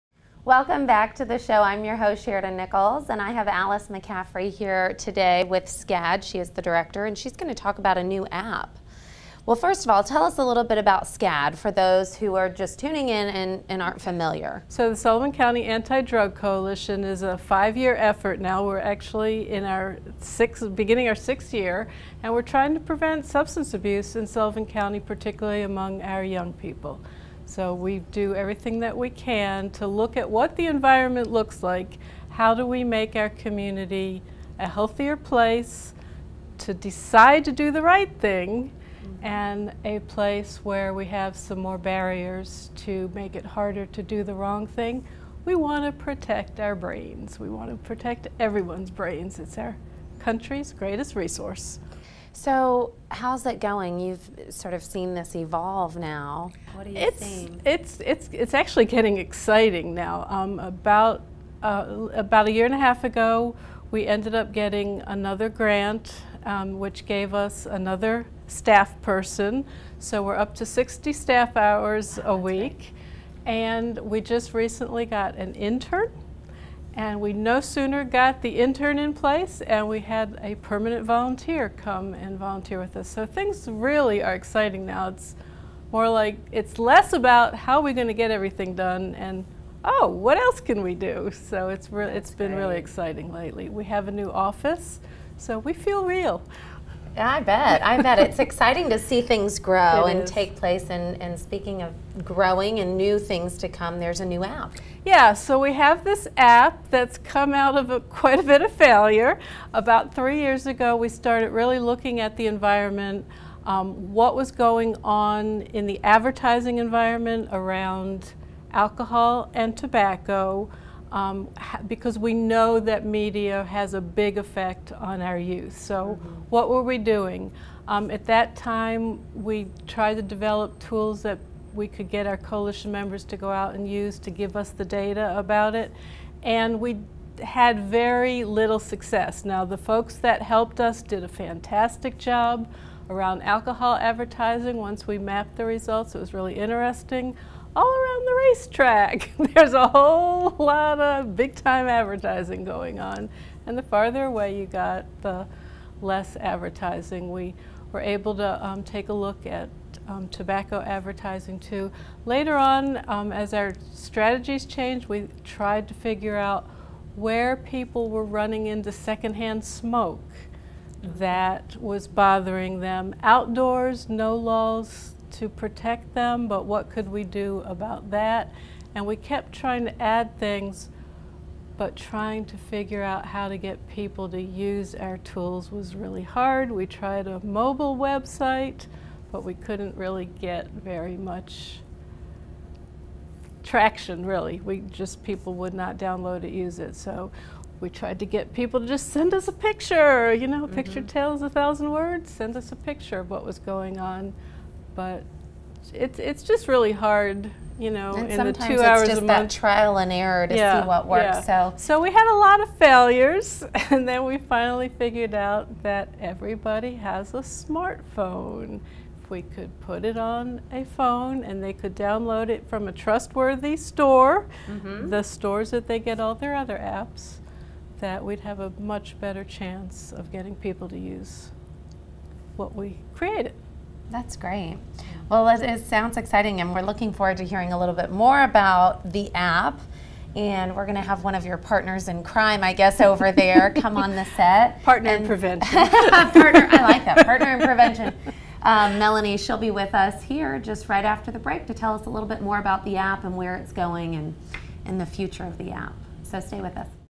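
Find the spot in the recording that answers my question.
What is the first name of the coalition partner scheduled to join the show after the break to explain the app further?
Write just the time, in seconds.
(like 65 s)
248 s.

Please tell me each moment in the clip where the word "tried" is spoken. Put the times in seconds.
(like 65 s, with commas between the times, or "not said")
129 s, 165 s, 186 s, 197 s.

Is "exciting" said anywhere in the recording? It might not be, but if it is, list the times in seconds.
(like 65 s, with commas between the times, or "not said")
59 s, 84 s, 92 s, 98 s, 236 s.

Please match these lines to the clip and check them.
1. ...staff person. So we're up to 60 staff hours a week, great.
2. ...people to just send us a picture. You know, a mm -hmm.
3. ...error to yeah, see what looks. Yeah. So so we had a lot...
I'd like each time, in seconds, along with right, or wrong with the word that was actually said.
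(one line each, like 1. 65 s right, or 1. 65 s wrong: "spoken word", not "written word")
1. 68 s right
2. 198 s right
3. 210 s wrong: "works", not "looks".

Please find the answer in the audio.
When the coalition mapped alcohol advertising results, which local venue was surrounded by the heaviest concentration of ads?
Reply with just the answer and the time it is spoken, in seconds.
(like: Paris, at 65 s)
The racetrack, at 148 s.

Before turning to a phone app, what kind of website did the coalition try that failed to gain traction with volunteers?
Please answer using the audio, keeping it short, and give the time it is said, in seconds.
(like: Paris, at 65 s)
A mobile website, at 187 s.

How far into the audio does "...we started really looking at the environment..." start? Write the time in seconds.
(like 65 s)
110 s.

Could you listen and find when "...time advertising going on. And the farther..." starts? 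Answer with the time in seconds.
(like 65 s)
151 s.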